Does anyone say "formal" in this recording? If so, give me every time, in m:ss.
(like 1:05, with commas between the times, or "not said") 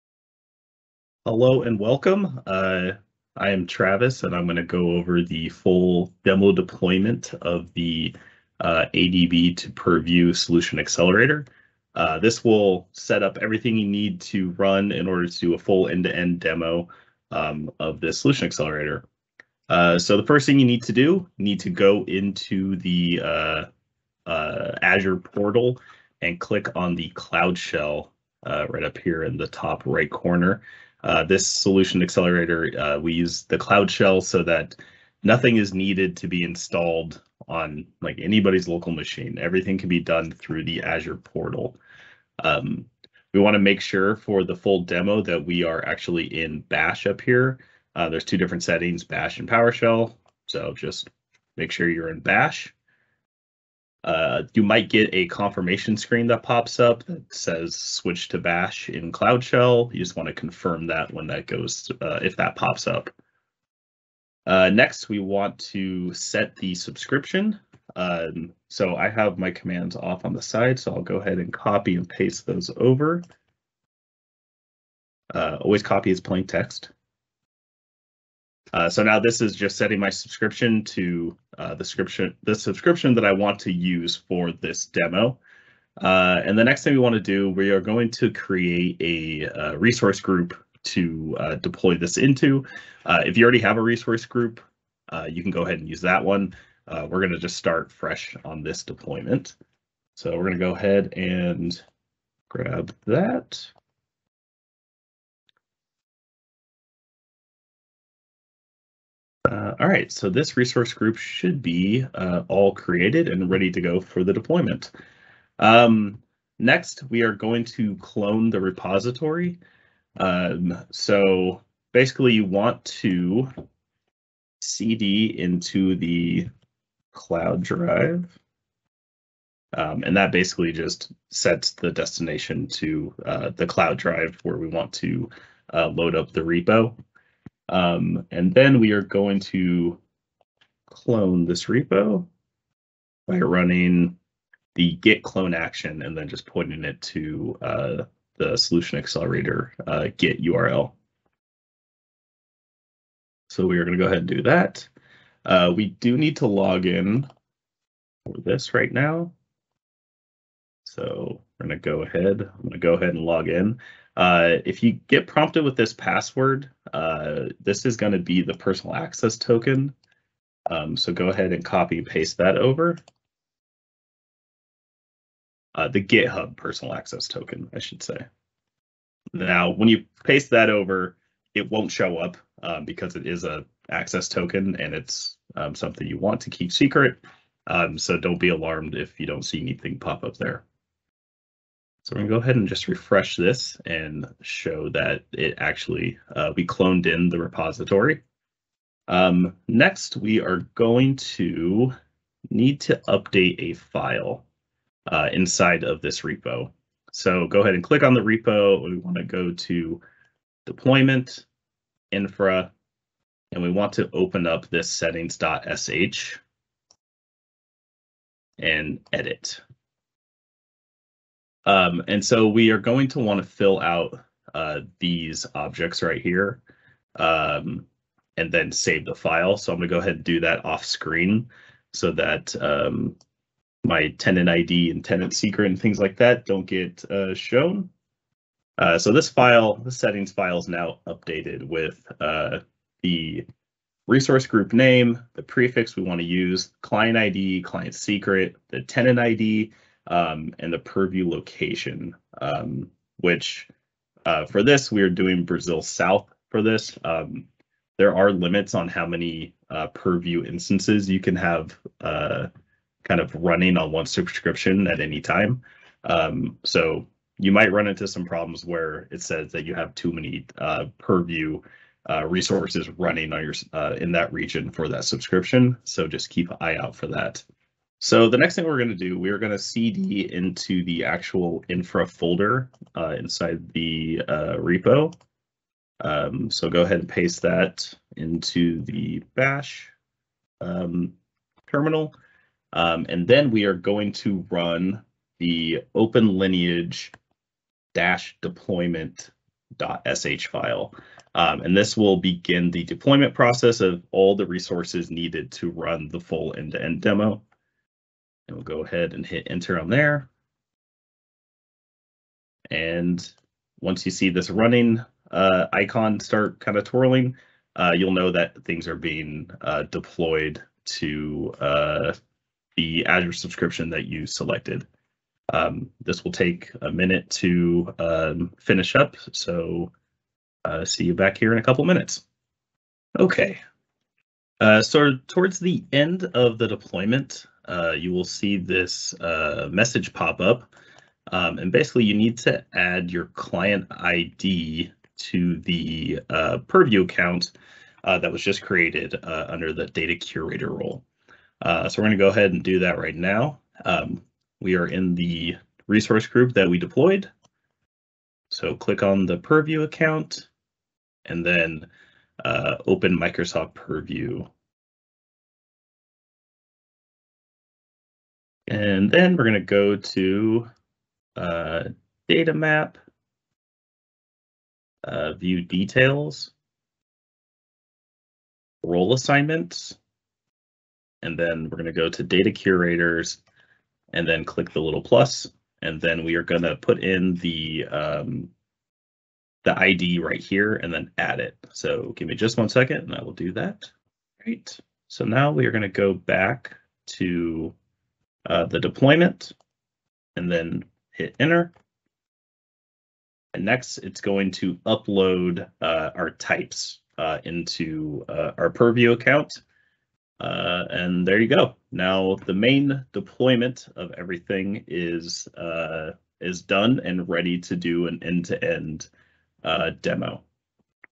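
not said.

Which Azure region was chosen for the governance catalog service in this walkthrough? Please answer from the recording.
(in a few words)
Brazil South.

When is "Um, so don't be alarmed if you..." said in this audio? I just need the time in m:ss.
3:07.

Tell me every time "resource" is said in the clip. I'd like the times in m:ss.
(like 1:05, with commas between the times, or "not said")
1:29, 1:33, 1:50, 4:04, 4:32, 5:04, 5:55.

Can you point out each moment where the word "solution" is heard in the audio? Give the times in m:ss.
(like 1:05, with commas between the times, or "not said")
0:10, 0:18, 0:31, 2:28.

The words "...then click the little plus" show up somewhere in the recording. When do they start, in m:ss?
6:24.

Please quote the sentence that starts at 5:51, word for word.
Uh, so we're gonna go ahead and do that right now.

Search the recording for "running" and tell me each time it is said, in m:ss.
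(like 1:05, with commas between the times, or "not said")
2:23, 4:23, 4:32, 5:14.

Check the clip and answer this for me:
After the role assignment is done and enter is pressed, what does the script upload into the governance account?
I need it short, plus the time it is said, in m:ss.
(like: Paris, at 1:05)
types, at 6:46.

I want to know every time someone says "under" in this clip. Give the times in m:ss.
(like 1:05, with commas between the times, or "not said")
5:49.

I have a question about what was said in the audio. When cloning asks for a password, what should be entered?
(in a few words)
GitHub personal access token.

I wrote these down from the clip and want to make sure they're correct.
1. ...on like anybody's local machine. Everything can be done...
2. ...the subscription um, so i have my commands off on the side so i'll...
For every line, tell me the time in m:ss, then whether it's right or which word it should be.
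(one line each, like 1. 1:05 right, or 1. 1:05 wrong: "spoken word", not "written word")
1. 0:37 right
2. 1:06 right.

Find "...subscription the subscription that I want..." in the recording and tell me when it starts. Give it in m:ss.
1:21.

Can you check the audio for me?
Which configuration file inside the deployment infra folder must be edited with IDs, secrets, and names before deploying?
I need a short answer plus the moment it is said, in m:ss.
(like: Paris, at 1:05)
settings.sh, at 3:34.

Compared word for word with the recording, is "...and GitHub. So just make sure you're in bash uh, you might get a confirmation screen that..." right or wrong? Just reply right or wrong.
wrong.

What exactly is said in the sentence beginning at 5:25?
Um, this will take a minute to um, finish up, so uh, see you back here in a couple minutes.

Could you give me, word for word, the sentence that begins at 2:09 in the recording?
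Um, and that basically just sets the destination to uh, the cloud drive where we want to uh, load up the repo.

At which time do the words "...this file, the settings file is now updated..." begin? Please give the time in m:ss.
3:59.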